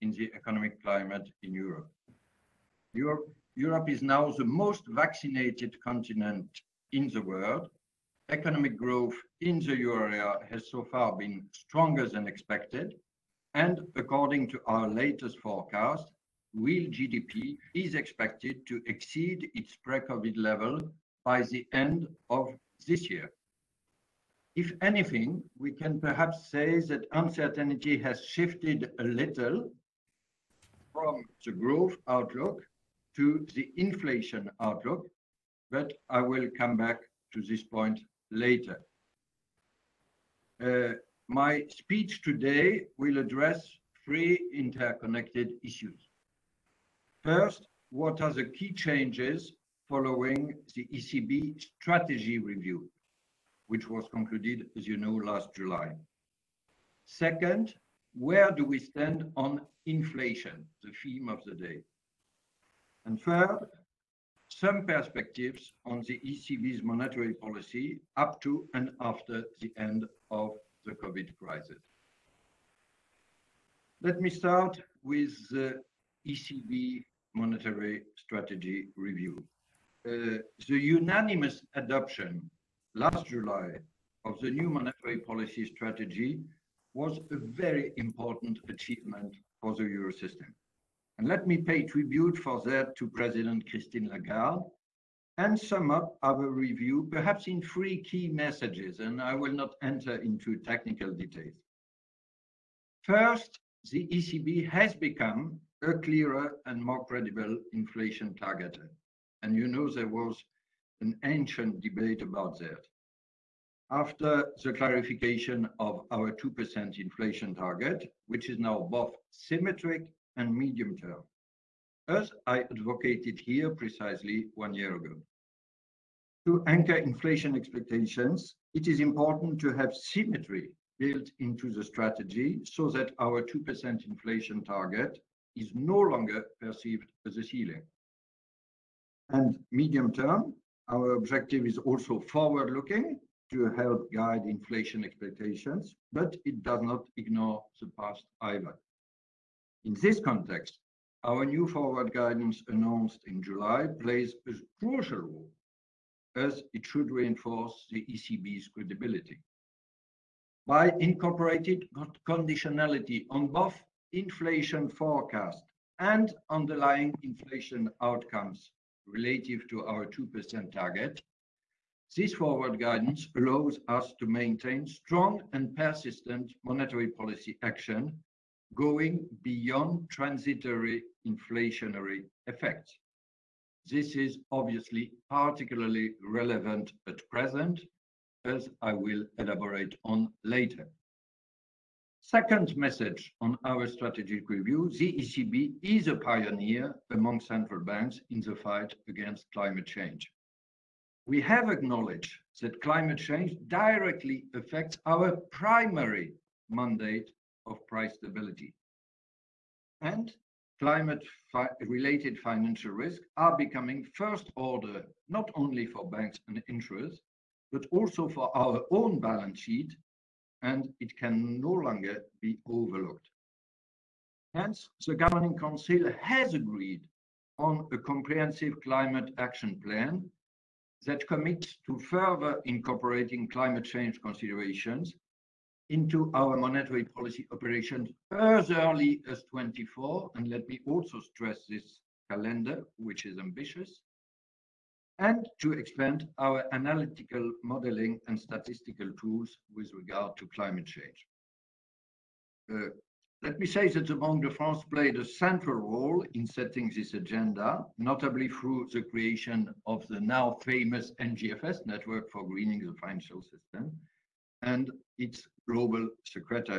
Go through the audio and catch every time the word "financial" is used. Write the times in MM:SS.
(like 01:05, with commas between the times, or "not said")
03:32, 04:23.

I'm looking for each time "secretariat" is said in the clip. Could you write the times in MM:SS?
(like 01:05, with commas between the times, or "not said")
04:26.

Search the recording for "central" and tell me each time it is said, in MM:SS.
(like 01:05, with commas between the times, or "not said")
03:17, 04:15.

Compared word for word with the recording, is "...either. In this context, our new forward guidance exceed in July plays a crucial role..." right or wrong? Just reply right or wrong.
wrong.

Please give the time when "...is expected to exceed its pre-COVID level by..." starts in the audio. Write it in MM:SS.
00:17.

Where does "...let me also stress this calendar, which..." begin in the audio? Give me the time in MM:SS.
04:00.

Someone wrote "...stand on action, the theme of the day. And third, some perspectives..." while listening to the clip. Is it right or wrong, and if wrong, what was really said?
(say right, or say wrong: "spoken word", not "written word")
wrong: "inflation", not "action".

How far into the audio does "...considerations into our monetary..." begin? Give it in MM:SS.
03:54.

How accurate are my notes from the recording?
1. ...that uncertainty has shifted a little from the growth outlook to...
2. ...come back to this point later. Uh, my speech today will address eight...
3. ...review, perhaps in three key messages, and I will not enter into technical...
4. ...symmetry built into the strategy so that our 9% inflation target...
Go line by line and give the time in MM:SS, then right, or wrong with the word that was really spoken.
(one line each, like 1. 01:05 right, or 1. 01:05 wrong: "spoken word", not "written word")
1. 00:26 right
2. 00:36 wrong: "three", not "eight"
3. 01:36 right
4. 02:09 wrong: "2", not "9".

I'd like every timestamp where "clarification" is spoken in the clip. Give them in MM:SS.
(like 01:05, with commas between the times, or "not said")
01:54.